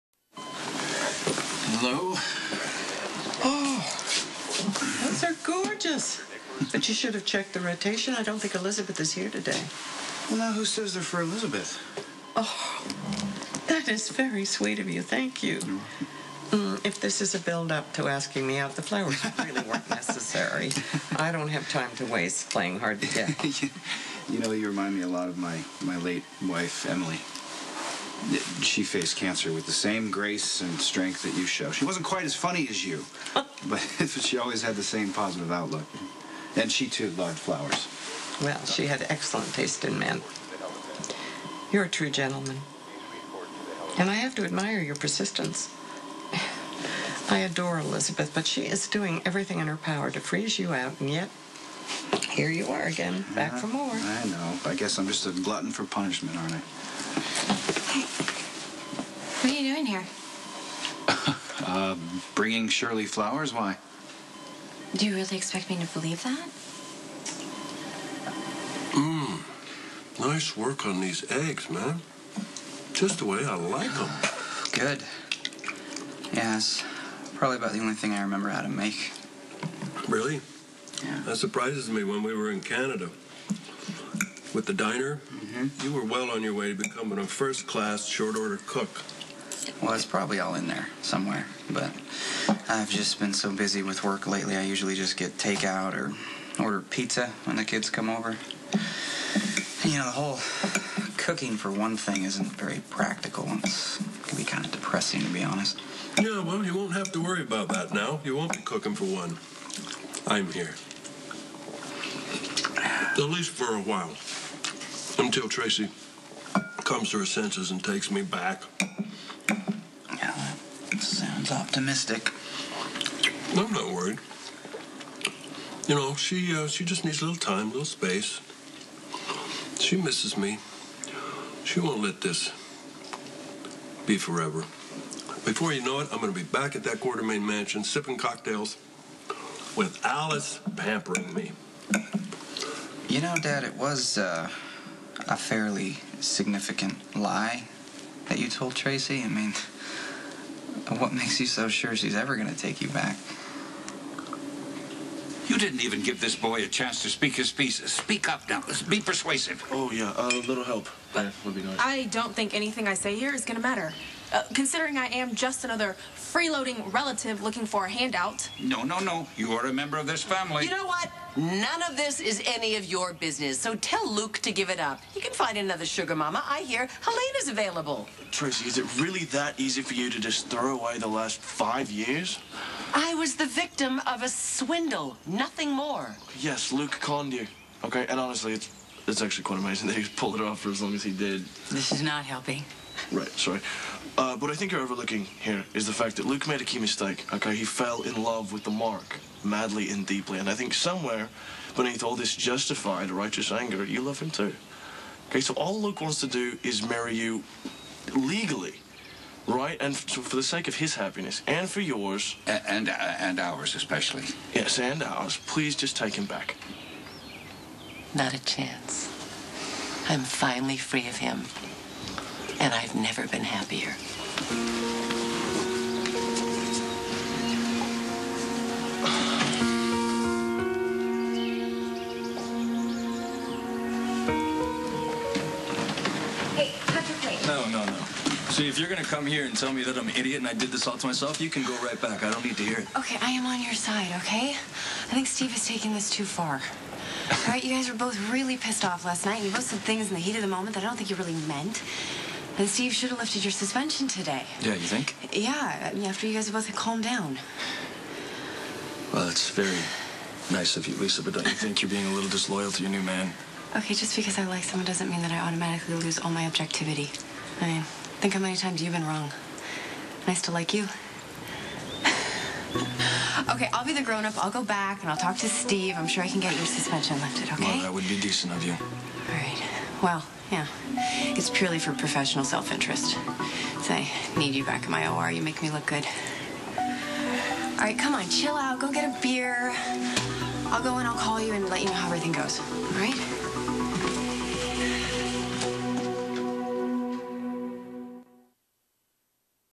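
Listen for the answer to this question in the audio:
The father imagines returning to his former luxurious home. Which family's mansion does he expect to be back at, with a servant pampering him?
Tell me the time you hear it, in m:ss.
2:16.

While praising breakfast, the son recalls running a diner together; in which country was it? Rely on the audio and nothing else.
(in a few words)
Canada.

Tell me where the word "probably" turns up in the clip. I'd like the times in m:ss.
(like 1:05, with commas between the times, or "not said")
1:17, 1:30.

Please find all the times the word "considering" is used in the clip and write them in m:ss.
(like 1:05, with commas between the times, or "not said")
2:44.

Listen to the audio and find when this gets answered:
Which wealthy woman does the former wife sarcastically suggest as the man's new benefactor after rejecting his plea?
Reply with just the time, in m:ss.
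2:56.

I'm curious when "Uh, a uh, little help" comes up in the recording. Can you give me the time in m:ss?
2:40.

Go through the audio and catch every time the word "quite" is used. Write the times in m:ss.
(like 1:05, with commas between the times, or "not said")
0:32, 3:09.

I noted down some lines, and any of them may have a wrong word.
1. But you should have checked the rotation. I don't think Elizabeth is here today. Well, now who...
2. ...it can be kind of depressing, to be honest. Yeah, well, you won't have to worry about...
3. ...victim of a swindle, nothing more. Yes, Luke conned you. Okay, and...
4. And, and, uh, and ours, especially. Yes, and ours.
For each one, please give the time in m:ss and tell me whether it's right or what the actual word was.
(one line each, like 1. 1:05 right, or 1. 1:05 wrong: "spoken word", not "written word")
1. 0:06 right
2. 1:43 right
3. 3:03 right
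4. 3:32 right.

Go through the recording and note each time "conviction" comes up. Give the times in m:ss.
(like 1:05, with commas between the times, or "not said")
not said.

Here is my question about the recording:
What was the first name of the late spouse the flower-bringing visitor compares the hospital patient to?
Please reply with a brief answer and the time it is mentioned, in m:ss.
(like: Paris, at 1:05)
Emily, at 0:26.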